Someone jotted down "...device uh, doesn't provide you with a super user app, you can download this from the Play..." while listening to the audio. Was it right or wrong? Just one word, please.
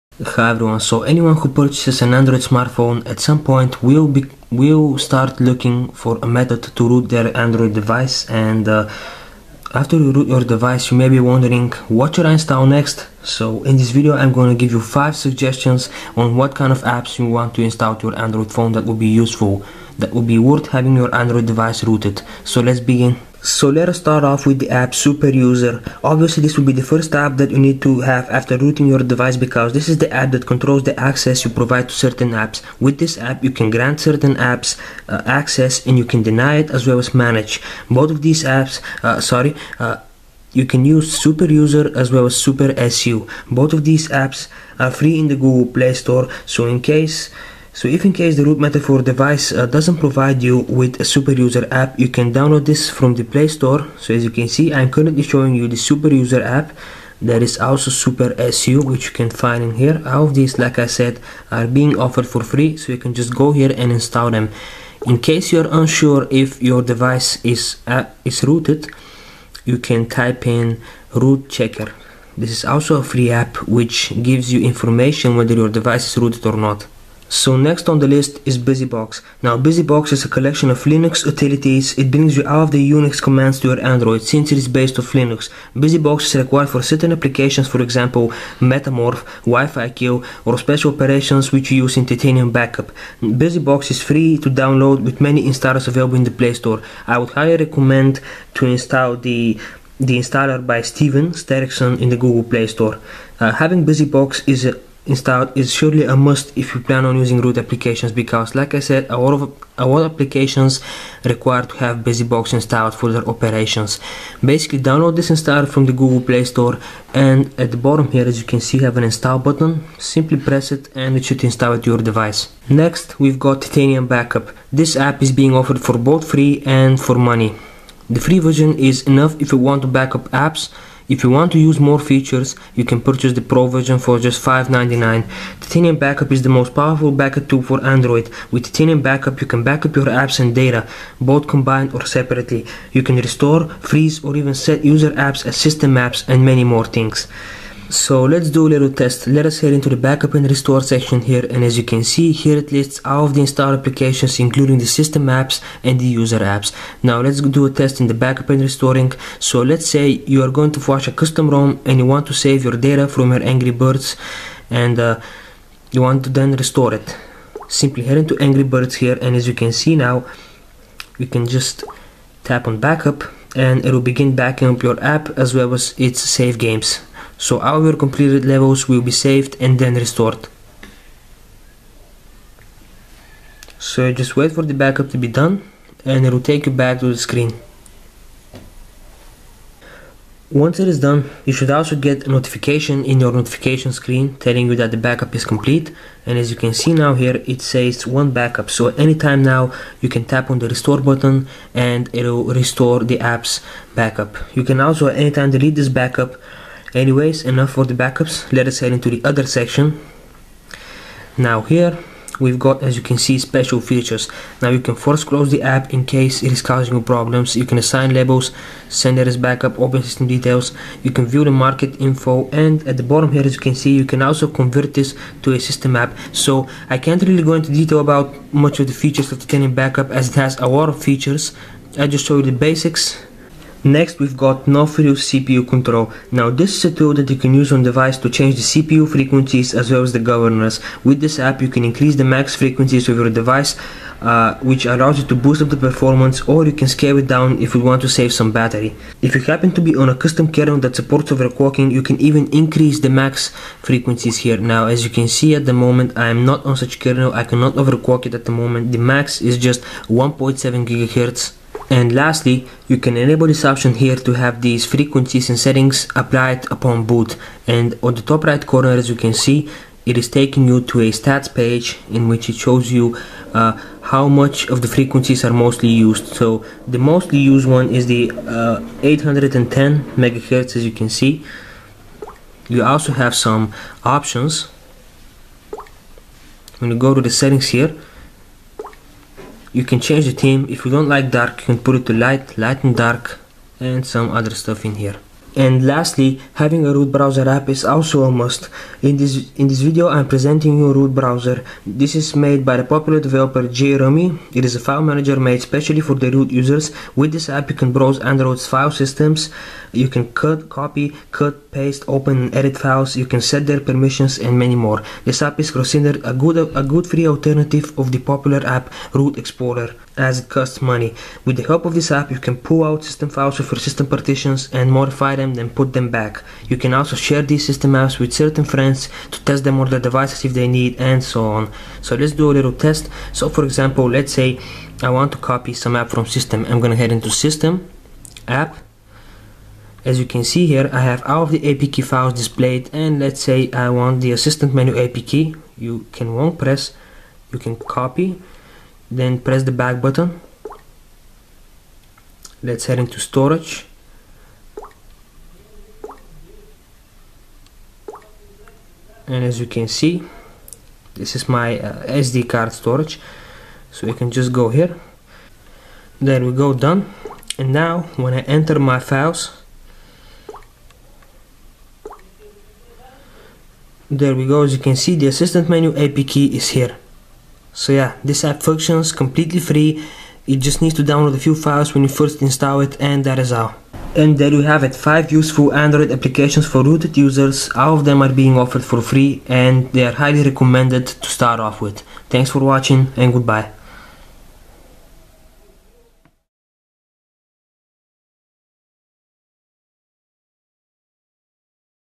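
right.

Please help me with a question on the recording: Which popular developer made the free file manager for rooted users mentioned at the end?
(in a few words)
JRummy.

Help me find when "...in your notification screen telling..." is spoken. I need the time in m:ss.
3:13.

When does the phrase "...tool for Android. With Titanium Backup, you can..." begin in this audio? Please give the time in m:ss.
2:17.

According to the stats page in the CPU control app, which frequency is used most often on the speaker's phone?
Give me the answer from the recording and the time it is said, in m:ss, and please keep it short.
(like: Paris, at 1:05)
810 MHz, at 4:39.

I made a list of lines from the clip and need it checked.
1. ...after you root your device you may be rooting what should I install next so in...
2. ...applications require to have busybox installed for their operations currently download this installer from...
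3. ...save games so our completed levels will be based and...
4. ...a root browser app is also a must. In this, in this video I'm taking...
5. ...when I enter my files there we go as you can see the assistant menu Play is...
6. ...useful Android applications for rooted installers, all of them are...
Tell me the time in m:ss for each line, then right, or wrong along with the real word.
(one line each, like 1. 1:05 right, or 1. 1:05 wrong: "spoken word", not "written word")
1. 0:09 wrong: "wondering", not "rooting"
2. 1:50 wrong: "basically", not "currently"
3. 2:56 wrong: "saved", not "based"
4. 4:56 wrong: "presenting", not "taking"
5. 6:08 wrong: "APK", not "Play"
6. 6:25 wrong: "users", not "installers".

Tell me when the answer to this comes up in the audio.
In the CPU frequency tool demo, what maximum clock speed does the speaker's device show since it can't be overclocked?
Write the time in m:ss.
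4:20.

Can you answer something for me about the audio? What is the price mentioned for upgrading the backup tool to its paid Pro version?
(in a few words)
$5.99.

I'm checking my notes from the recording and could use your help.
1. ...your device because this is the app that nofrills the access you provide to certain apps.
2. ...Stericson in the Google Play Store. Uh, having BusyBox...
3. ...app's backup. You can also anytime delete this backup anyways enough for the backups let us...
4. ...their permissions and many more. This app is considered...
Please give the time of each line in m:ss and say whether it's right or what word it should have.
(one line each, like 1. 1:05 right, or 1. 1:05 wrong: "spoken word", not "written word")
1. 0:28 wrong: "controls", not "nofrills"
2. 1:41 right
3. 3:23 right
4. 5:13 right.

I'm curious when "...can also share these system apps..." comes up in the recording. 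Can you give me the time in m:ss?
5:26.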